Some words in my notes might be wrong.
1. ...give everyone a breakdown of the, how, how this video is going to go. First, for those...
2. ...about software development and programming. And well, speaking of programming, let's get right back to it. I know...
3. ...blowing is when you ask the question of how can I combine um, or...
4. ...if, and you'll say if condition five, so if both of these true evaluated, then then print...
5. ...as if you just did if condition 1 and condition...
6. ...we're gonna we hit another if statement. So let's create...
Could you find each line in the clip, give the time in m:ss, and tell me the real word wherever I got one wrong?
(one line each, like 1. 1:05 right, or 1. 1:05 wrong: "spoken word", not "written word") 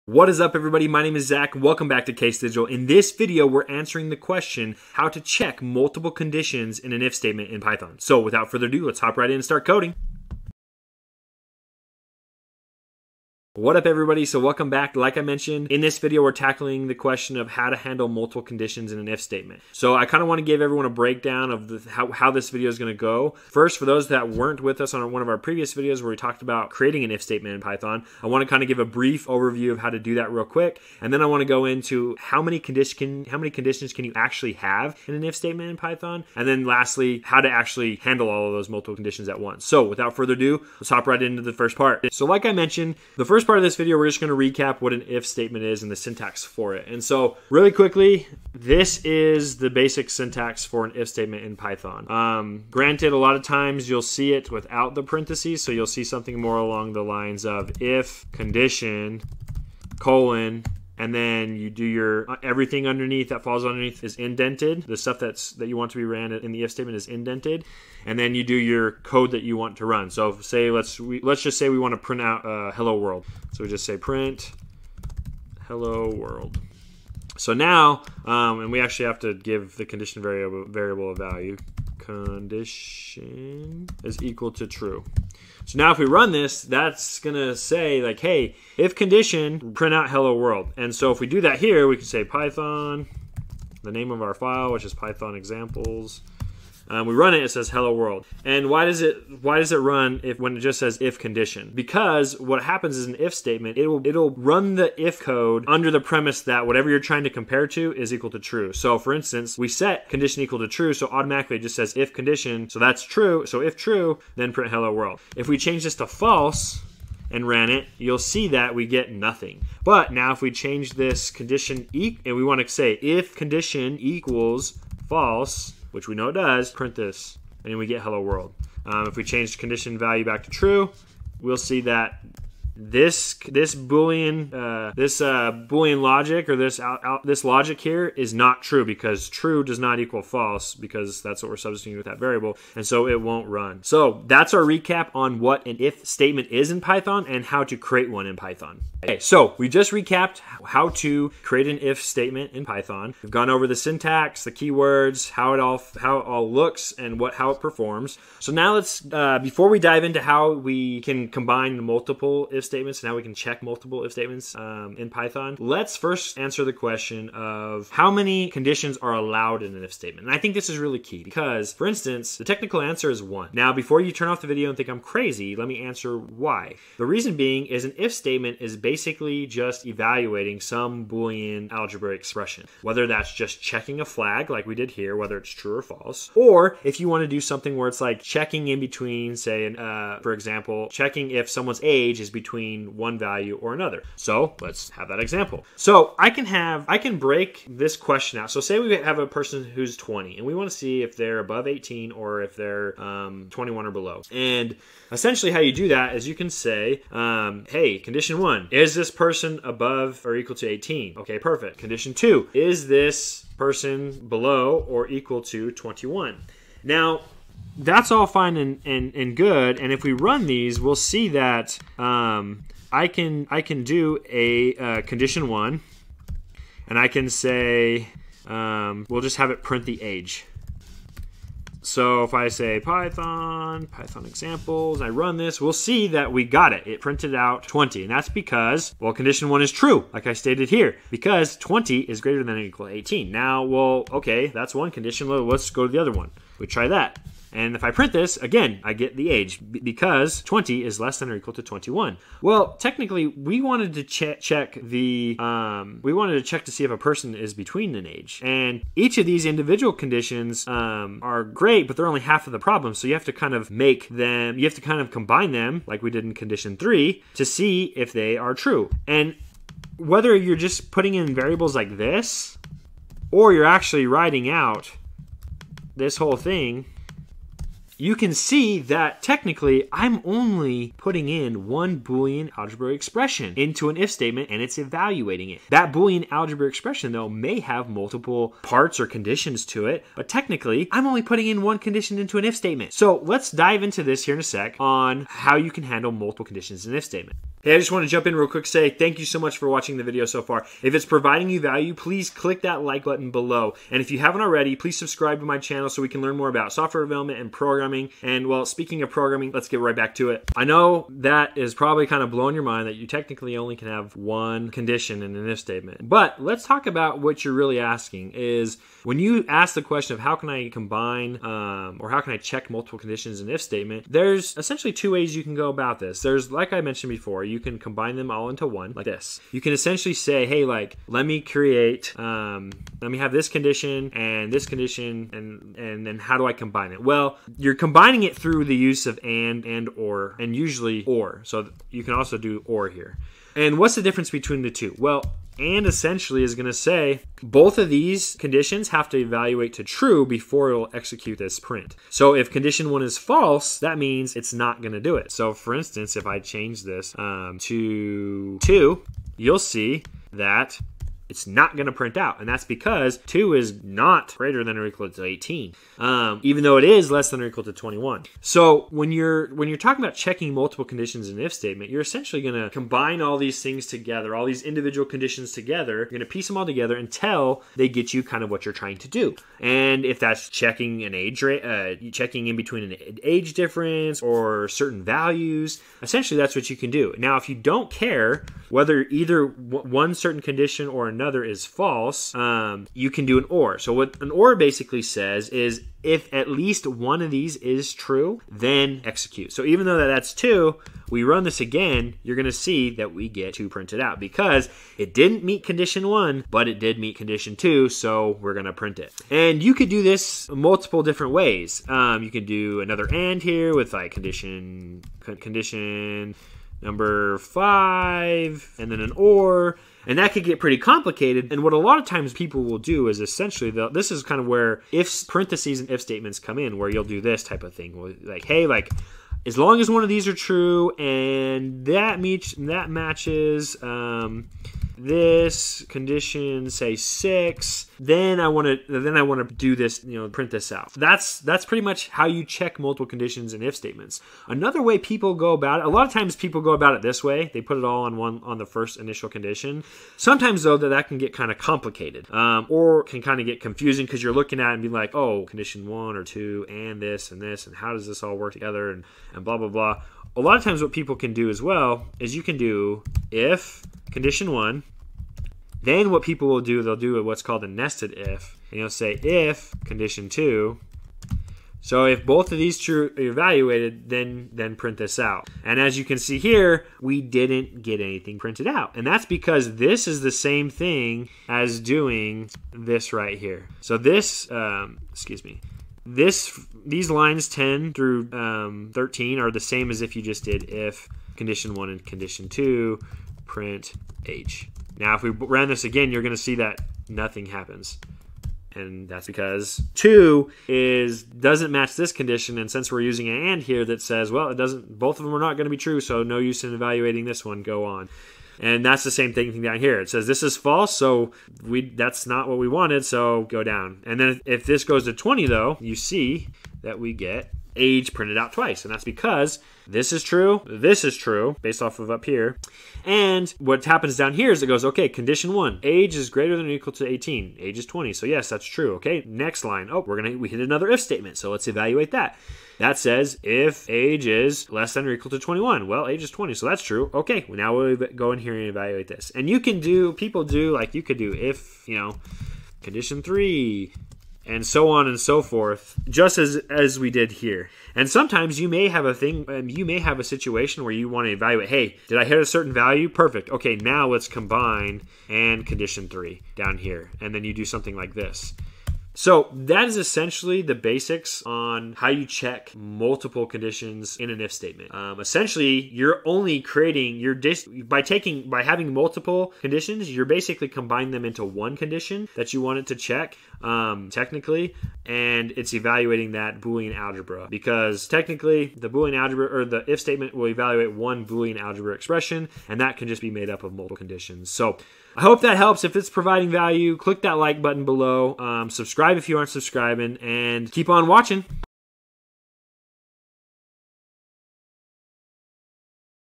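1. 0:20 right
2. 5:06 right
3. 5:17 wrong: "asking", not "blowing"
4. 7:48 wrong: "two", not "five"
5. 8:09 right
6. 8:50 wrong: "evaluate", not "create".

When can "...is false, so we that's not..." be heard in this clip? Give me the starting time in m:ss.
8:30.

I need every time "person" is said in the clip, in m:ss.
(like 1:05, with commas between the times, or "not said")
3:19, 3:29, 3:33, 4:16.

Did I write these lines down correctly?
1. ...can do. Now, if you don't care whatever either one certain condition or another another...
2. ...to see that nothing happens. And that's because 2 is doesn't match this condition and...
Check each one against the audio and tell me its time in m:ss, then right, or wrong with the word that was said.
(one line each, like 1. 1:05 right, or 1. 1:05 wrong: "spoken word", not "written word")
1. 6:26 wrong: "whether", not "whatever"
2. 8:16 right.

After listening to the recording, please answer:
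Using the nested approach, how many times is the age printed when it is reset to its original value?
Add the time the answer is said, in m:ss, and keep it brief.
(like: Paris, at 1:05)
2, at 8:38.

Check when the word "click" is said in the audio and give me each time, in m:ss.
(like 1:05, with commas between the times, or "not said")
5:02, 9:46.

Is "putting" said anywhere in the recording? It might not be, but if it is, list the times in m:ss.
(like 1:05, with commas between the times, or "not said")
4:30, 4:40, 4:51.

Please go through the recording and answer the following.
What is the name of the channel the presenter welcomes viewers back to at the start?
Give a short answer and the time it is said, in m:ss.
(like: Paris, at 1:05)
Case Digital, at 0:02.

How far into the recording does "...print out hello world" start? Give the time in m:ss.
1:29.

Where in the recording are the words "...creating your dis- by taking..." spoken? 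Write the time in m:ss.
9:26.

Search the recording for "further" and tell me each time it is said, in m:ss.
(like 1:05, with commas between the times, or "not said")
0:08, 0:40.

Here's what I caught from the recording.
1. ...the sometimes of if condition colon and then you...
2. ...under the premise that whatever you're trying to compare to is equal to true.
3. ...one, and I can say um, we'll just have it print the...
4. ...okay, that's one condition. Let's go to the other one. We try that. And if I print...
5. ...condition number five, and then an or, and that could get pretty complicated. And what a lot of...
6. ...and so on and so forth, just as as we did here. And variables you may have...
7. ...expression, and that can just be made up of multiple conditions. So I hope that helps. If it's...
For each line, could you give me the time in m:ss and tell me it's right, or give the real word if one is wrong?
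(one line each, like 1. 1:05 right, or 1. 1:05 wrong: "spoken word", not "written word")
1. 0:56 wrong: "lines", not "sometimes"
2. 1:45 right
3. 3:45 right
4. 4:04 right
5. 6:55 right
6. 9:04 wrong: "sometimes", not "variables"
7. 9:41 right.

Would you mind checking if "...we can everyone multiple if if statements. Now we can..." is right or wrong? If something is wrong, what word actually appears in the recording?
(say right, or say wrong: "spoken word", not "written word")
wrong: "combine", not "everyone".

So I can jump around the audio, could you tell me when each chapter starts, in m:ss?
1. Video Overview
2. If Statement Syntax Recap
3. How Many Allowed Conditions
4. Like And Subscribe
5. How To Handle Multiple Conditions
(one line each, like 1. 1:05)
1. 0:13
2. 0:45
3. 1:05
4. 3:55
5. 4:09.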